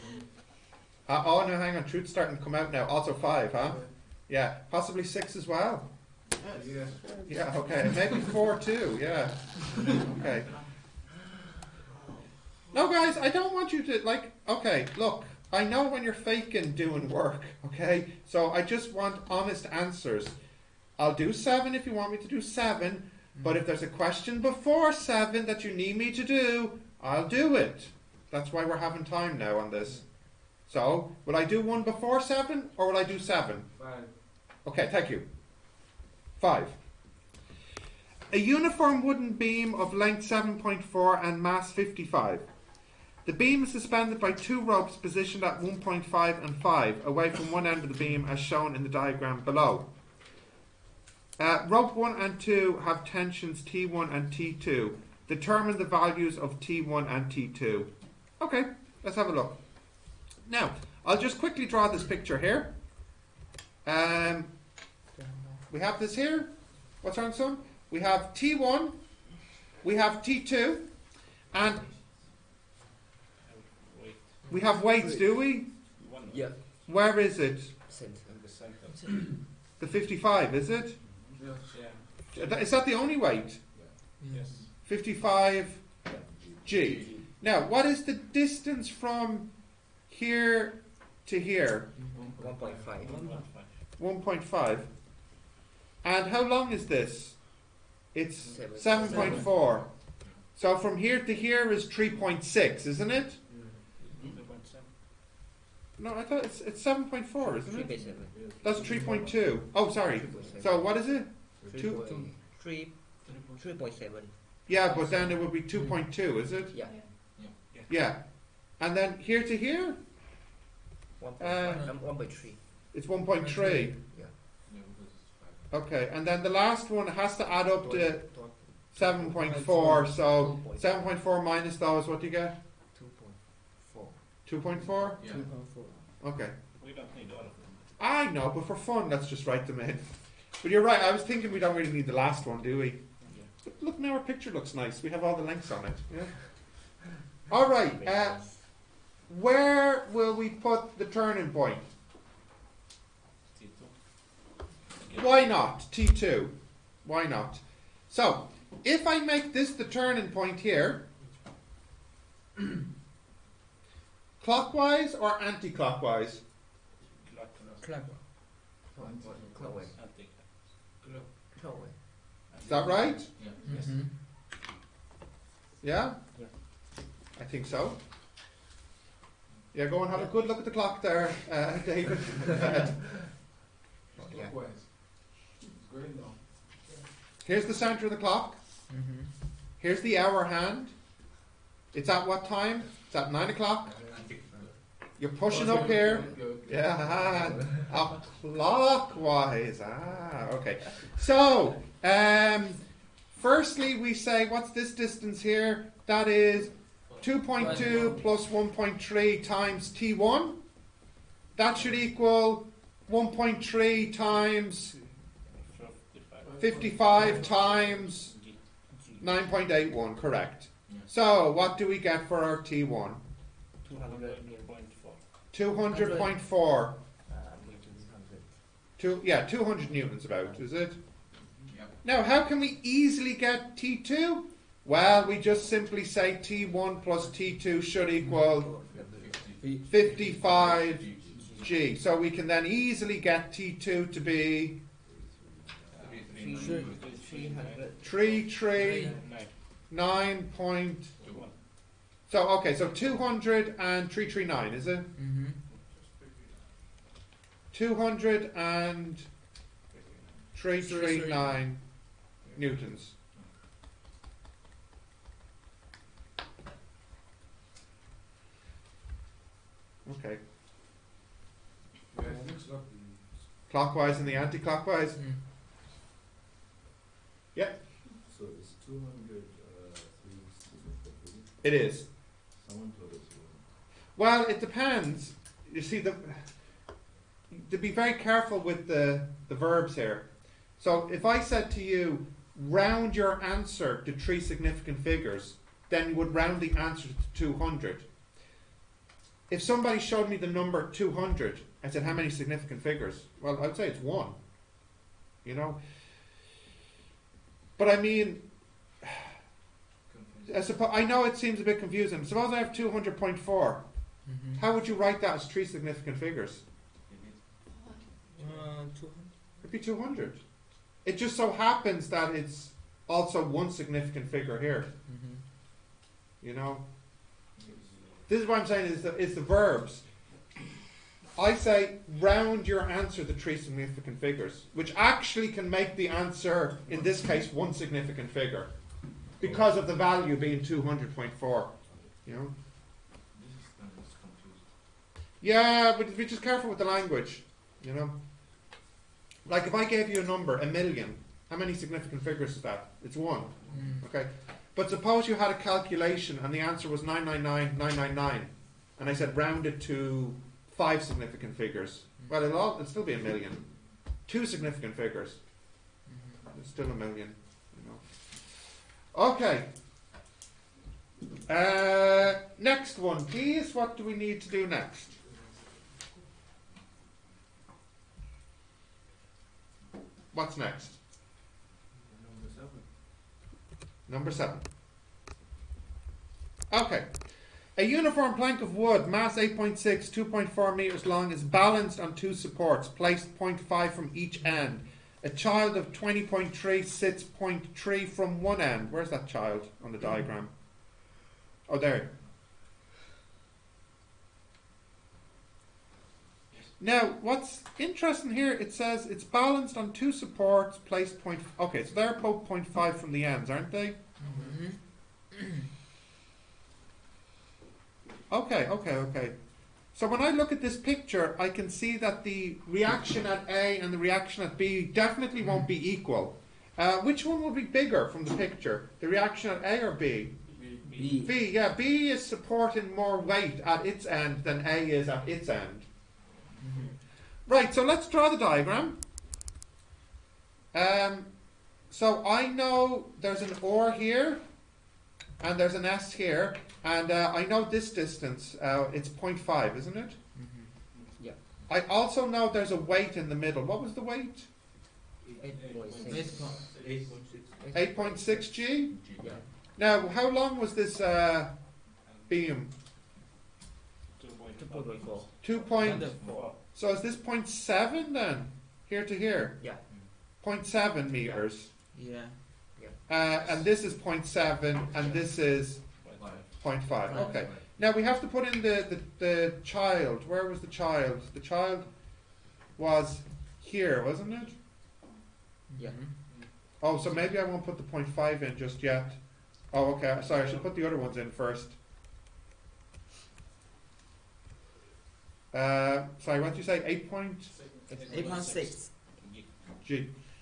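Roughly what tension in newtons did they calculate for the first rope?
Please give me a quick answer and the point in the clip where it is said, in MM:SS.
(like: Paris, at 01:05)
200 newtons, at 03:49.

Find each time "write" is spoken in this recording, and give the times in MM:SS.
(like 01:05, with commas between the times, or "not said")
02:19, 05:14.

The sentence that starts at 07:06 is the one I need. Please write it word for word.
Uh, which one will be bigger from the picture?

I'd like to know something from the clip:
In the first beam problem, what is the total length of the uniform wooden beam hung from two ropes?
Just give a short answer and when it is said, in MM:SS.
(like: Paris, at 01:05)
7.4, at 00:39.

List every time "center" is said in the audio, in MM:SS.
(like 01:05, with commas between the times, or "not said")
03:07.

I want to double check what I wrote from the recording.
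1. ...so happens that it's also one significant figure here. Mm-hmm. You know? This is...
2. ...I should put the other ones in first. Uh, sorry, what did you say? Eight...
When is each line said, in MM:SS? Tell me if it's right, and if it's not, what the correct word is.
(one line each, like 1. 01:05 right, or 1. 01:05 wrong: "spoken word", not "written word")
1. 05:21 right
2. 08:10 right.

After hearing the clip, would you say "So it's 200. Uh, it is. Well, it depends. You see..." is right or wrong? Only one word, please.
right.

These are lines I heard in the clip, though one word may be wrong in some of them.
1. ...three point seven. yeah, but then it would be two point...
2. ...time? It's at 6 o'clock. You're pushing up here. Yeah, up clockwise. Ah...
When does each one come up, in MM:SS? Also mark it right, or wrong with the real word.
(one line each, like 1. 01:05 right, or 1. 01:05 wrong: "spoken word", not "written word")
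1. 01:53 right
2. 03:12 wrong: "9", not "6".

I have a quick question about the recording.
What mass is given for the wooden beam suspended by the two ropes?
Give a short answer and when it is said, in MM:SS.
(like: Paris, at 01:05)
55, at 00:41.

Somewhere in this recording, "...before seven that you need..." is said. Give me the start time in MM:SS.
00:24.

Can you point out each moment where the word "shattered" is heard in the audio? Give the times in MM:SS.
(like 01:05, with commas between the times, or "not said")
not said.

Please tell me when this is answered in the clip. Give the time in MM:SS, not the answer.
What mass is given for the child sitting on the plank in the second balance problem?
06:35.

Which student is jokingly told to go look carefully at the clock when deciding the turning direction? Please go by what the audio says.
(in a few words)
David.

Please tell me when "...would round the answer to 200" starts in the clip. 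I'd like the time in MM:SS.
04:56.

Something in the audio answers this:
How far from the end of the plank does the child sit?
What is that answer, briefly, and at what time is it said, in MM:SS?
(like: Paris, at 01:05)
0.3, at 06:37.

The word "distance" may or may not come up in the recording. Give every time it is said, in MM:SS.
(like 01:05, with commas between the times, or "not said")
01:28, 03:24, 07:27.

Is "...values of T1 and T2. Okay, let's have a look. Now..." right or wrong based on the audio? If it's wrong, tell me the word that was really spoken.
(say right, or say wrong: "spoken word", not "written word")
right.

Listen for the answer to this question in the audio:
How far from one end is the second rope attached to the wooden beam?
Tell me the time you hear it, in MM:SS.
00:46.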